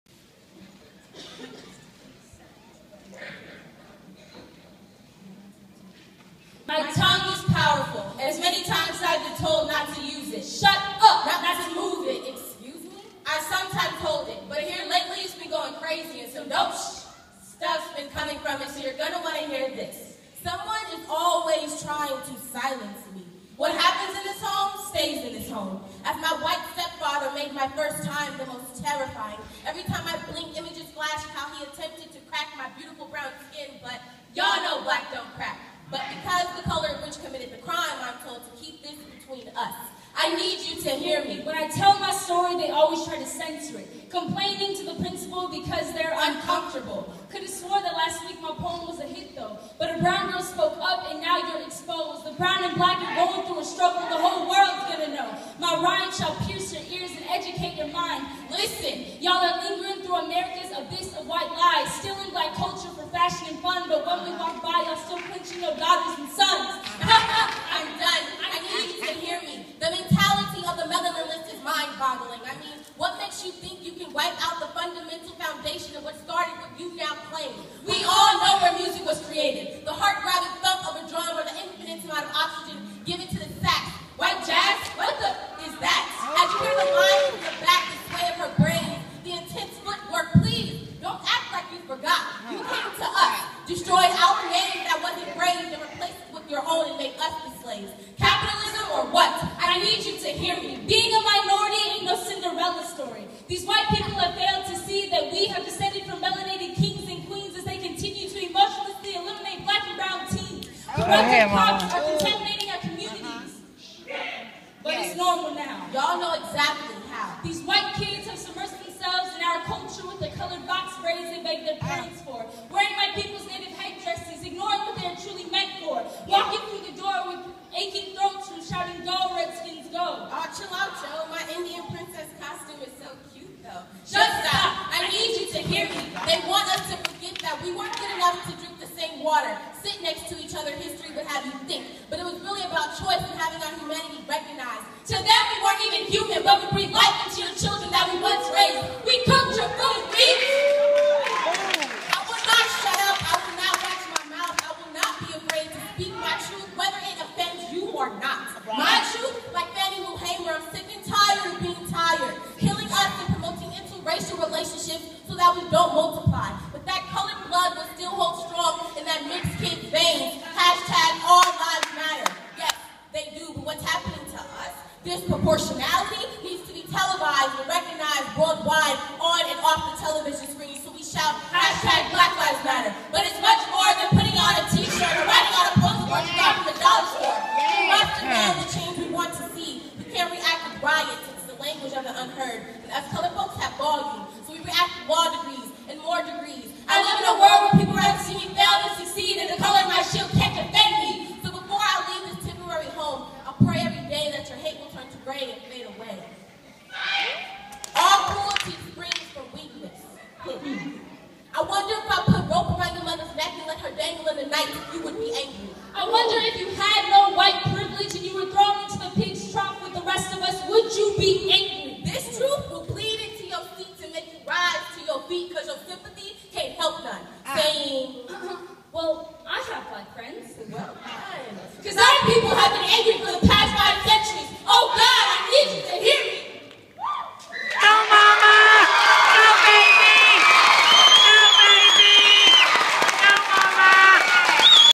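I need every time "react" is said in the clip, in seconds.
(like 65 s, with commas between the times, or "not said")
190 s, 194 s.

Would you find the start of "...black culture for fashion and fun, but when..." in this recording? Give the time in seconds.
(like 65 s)
62 s.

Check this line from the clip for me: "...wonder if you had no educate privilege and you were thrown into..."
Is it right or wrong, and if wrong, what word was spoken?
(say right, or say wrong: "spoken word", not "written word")
wrong: "white", not "educate".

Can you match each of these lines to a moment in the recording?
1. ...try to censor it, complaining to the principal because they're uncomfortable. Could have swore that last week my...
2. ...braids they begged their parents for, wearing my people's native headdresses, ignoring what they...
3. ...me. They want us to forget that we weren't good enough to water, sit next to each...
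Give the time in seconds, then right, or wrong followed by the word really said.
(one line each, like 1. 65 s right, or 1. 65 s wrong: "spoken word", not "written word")
1. 43 s right
2. 121 s right
3. 135 s right.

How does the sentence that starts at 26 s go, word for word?
As my white stepfather made my first time the most terrifying.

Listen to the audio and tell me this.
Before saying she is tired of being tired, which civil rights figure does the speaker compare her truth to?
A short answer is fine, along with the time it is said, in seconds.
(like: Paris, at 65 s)
Fannie Lou Hamer, at 159 s.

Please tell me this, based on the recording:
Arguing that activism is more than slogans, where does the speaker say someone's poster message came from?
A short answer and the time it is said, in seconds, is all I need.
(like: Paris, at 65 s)
The dollar store, at 186 s.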